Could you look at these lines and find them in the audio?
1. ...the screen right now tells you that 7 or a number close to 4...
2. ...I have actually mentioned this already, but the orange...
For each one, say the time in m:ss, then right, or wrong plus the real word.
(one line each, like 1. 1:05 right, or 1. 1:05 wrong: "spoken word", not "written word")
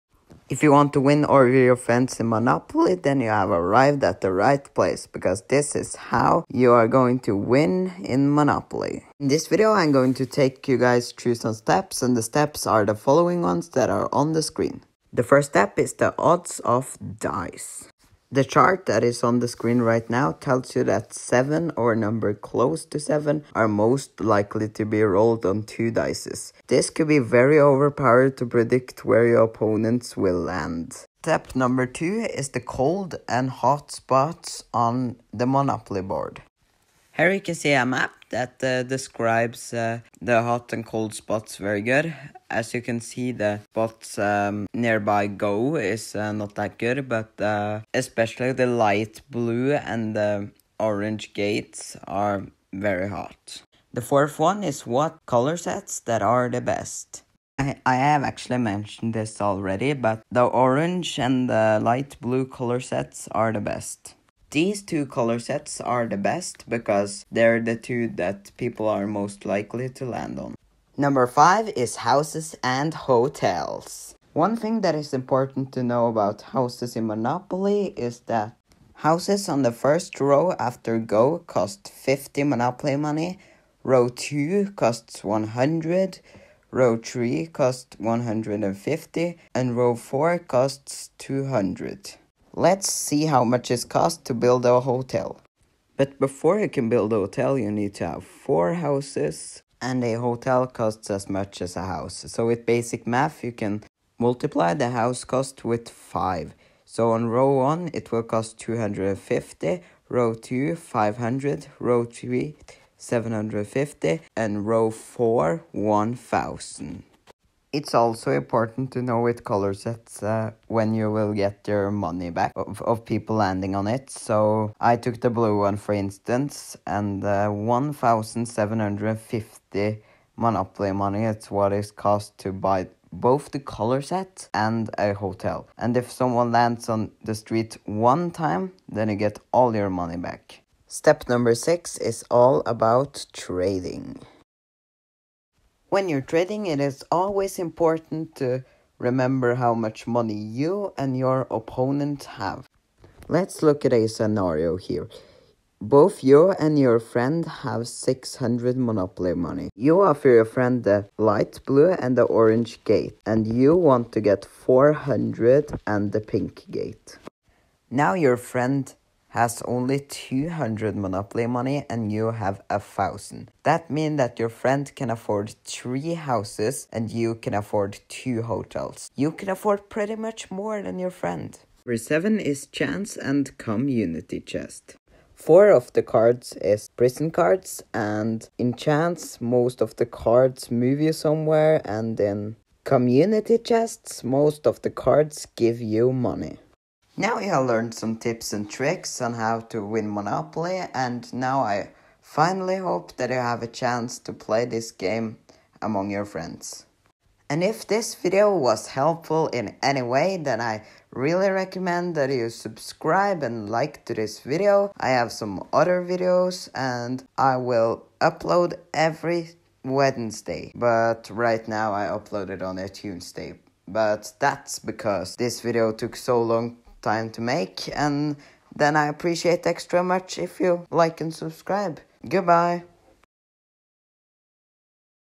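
1. 0:19 wrong: "7", not "4"
2. 0:57 right.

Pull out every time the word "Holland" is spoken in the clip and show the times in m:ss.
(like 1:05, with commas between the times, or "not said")
not said.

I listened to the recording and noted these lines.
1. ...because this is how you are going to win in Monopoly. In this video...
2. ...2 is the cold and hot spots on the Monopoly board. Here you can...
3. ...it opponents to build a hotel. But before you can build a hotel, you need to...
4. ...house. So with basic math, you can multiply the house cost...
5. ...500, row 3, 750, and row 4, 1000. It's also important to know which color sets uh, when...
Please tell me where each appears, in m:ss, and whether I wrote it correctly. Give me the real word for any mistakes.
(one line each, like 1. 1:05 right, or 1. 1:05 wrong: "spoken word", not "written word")
1. 0:05 right
2. 0:31 right
3. 1:33 wrong: "costs", not "opponents"
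4. 1:41 right
5. 1:50 right.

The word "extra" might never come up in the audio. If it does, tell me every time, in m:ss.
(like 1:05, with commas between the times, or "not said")
3:49.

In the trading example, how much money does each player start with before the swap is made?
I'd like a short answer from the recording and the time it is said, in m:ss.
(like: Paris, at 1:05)
600, at 2:37.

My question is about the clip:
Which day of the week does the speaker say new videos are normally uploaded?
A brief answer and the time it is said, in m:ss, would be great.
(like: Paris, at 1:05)
Wednesday, at 3:39.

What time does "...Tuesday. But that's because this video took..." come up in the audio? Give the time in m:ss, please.
3:42.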